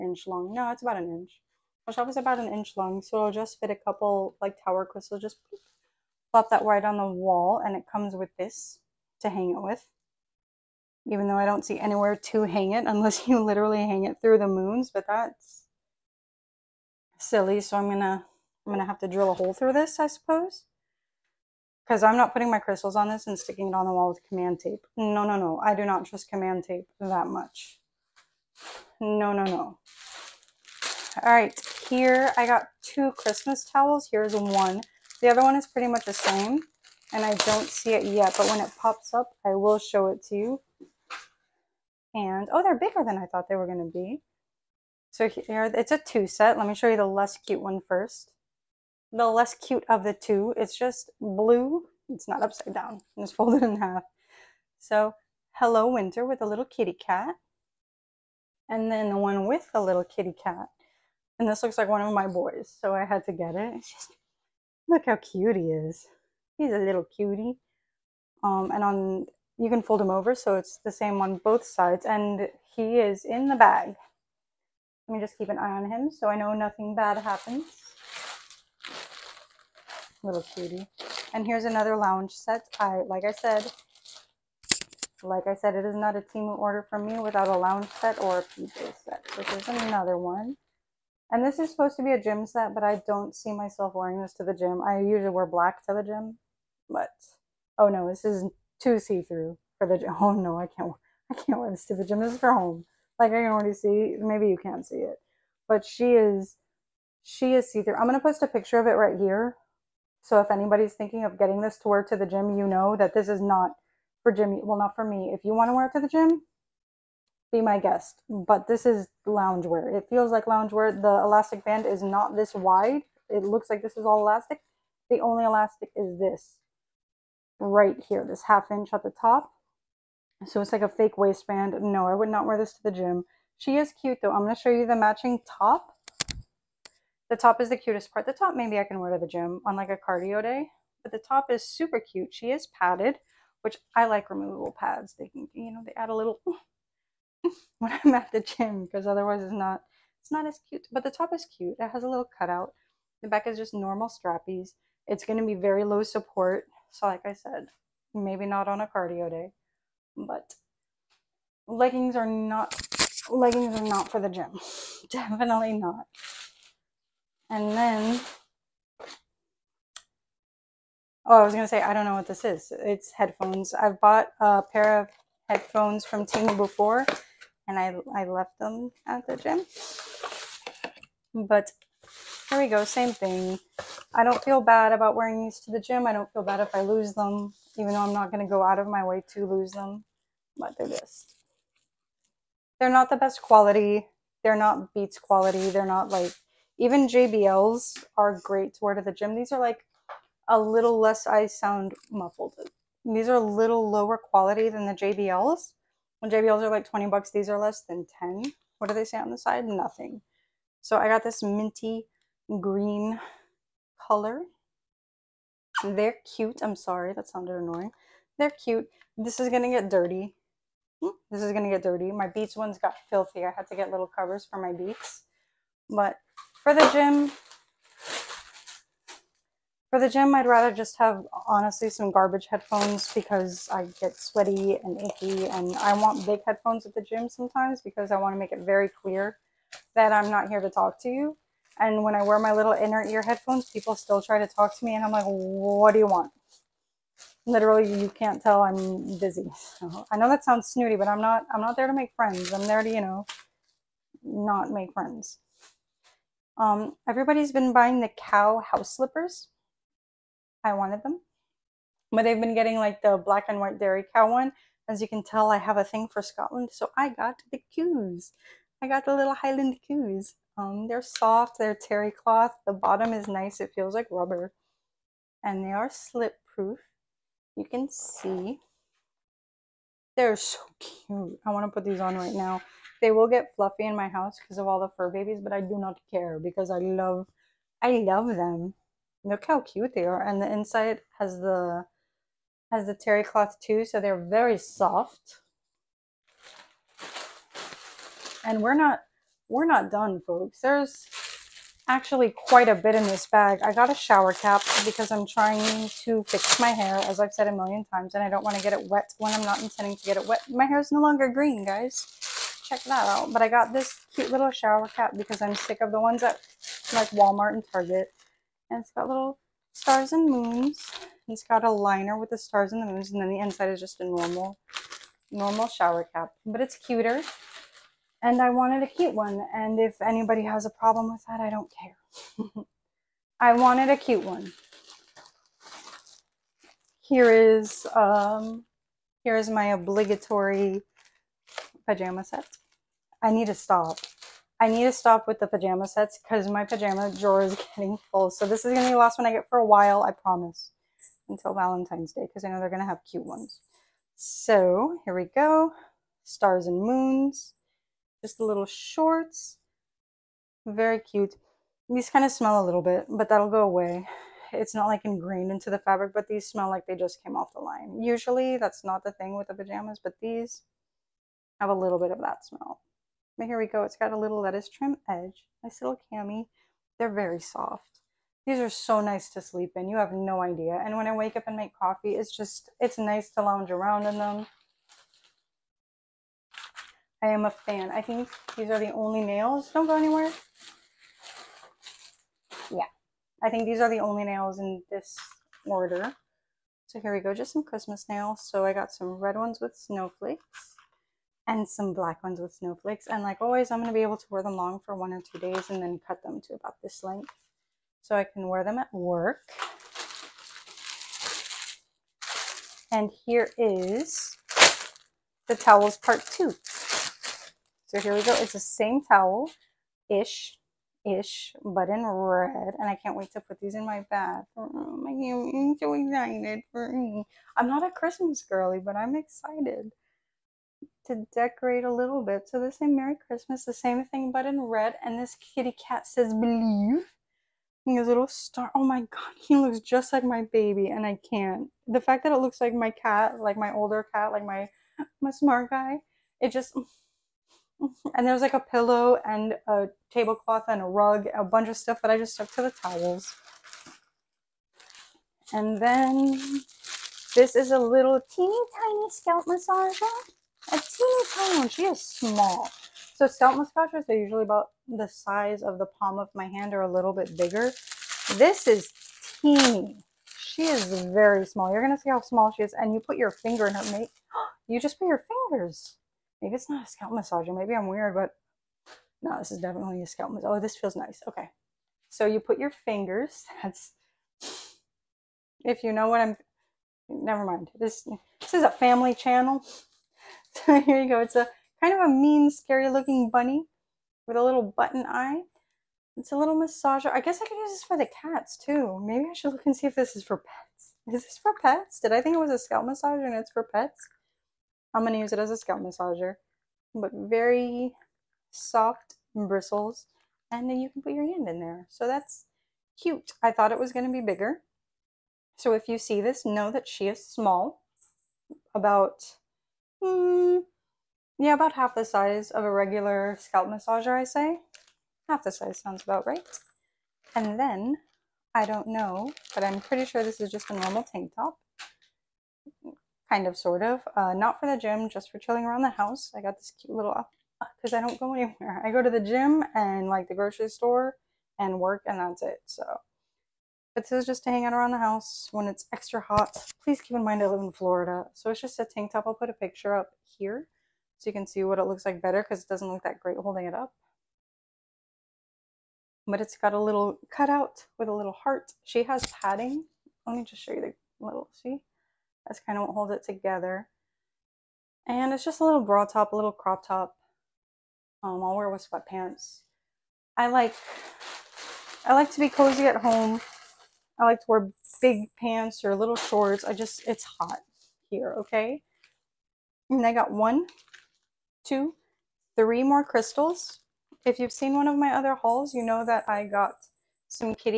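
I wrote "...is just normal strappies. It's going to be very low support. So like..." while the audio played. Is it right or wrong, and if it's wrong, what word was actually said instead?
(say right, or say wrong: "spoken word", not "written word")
right.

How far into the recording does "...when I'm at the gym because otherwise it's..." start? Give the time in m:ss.
2:27.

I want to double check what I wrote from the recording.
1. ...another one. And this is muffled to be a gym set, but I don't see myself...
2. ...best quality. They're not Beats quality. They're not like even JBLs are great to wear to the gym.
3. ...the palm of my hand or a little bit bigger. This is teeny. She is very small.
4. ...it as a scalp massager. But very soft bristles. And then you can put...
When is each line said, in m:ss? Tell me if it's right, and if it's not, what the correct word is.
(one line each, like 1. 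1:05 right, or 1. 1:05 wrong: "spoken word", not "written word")
1. 1:29 wrong: "supposed", not "muffled"
2. 3:13 right
3. 7:45 right
4. 8:25 right.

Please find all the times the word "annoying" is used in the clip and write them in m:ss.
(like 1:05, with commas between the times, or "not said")
3:37.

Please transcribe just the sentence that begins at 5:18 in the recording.
And it's got little stars and moons.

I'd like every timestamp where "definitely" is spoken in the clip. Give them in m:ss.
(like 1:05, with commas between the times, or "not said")
2:45, 7:59.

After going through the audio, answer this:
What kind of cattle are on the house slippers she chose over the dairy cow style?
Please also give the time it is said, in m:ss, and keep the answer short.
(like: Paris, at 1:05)
Highland coos, at 4:29.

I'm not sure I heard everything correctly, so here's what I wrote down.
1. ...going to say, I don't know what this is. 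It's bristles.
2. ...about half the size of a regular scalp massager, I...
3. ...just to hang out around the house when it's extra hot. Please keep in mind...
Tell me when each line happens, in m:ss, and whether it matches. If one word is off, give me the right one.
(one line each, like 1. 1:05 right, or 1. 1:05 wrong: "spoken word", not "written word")
1. 2:51 wrong: "headphones", not "bristles"
2. 8:41 right
3. 9:04 right.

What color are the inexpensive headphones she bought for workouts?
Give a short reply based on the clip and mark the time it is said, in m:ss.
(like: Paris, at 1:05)
minty green, at 3:31.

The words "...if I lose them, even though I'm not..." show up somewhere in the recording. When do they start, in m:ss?
3:06.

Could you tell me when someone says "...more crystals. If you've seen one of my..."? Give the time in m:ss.
9:42.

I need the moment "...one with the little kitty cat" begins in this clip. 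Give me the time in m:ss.
0:59.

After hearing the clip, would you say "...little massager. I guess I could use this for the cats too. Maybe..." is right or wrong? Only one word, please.
right.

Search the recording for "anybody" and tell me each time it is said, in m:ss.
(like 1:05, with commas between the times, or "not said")
1:50, 5:30.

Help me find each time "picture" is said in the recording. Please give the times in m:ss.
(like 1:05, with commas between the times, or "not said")
1:48, 9:09.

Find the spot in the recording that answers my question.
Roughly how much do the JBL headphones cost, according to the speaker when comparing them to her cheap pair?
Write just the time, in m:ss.
3:26.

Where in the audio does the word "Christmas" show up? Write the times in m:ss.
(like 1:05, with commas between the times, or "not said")
0:33, 6:37, 7:07, 7:13.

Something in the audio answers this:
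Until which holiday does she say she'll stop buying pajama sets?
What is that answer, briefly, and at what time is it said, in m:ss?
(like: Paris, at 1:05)
Valentine's Day, at 5:51.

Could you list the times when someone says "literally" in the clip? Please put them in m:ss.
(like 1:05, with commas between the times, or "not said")
0:13, 4:07.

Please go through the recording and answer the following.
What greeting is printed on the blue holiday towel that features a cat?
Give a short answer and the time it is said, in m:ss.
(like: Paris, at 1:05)
Hello Winter, at 0:55.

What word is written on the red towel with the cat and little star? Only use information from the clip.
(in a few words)
believe.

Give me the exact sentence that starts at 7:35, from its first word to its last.
And then this is a little teeny tiny scalp massager a teeny tiny one.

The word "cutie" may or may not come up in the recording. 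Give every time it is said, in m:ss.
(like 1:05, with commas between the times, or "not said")
1:07, 1:20.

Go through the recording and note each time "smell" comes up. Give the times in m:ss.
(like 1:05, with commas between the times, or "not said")
6:02, 6:06, 6:12.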